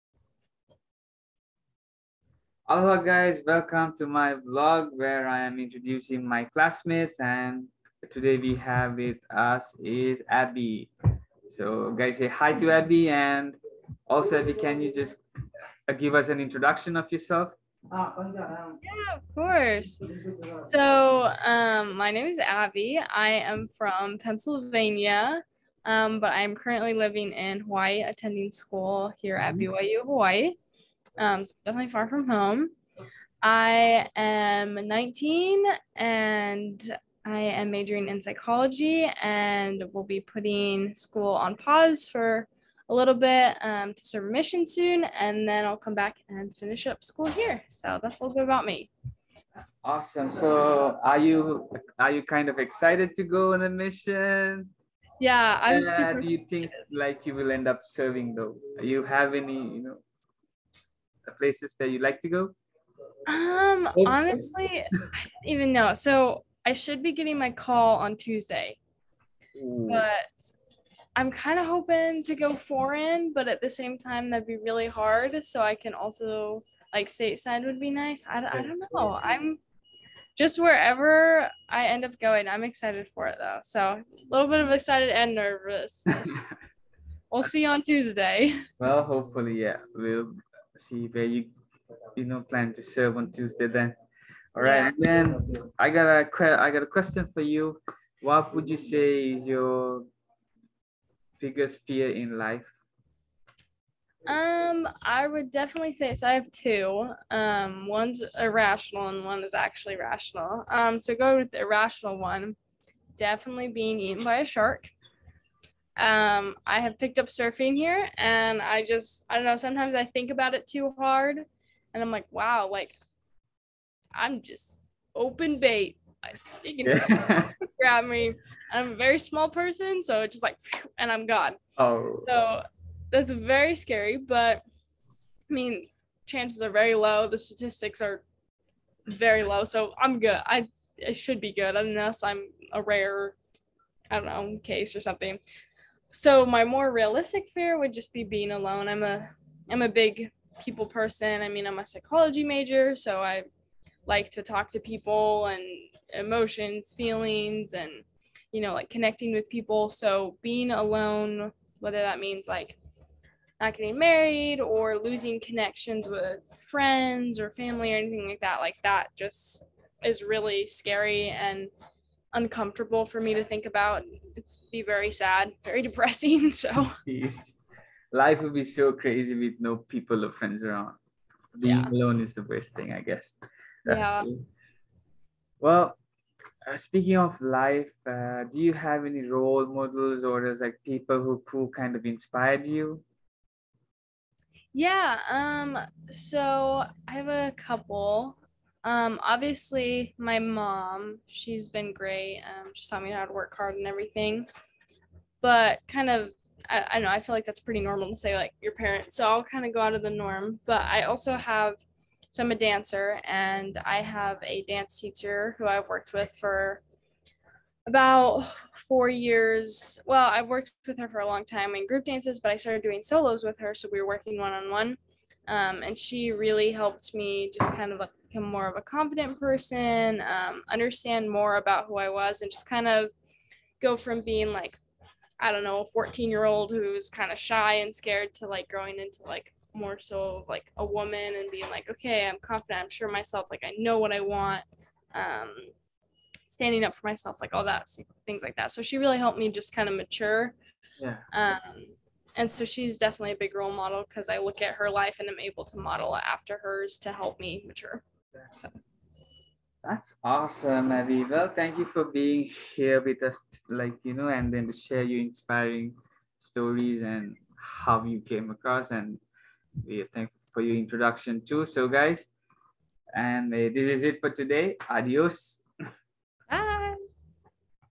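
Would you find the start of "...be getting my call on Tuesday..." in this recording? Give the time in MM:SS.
01:07.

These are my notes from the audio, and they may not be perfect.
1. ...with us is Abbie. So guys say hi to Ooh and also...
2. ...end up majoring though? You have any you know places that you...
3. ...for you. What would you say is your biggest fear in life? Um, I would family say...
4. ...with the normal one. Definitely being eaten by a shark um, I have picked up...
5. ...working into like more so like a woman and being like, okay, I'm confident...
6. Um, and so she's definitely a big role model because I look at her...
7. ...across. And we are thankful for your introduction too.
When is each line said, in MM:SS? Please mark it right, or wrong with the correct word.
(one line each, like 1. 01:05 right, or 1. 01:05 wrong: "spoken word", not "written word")
1. 00:08 wrong: "Abbie", not "Ooh"
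2. 00:57 wrong: "serving", not "majoring"
3. 01:37 wrong: "definitely", not "family"
4. 01:51 wrong: "irrational", not "normal"
5. 03:58 wrong: "growing", not "working"
6. 04:11 right
7. 04:28 right.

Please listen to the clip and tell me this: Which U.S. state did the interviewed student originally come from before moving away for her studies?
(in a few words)
Pennsylvania.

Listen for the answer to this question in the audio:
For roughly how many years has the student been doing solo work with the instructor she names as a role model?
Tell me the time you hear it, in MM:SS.
03:38.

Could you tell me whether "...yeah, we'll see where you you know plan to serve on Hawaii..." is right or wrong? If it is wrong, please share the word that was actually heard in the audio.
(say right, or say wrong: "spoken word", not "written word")
wrong: "Tuesday", not "Hawaii".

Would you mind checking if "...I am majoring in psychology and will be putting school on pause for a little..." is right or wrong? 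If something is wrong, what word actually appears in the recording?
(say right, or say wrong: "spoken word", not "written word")
right.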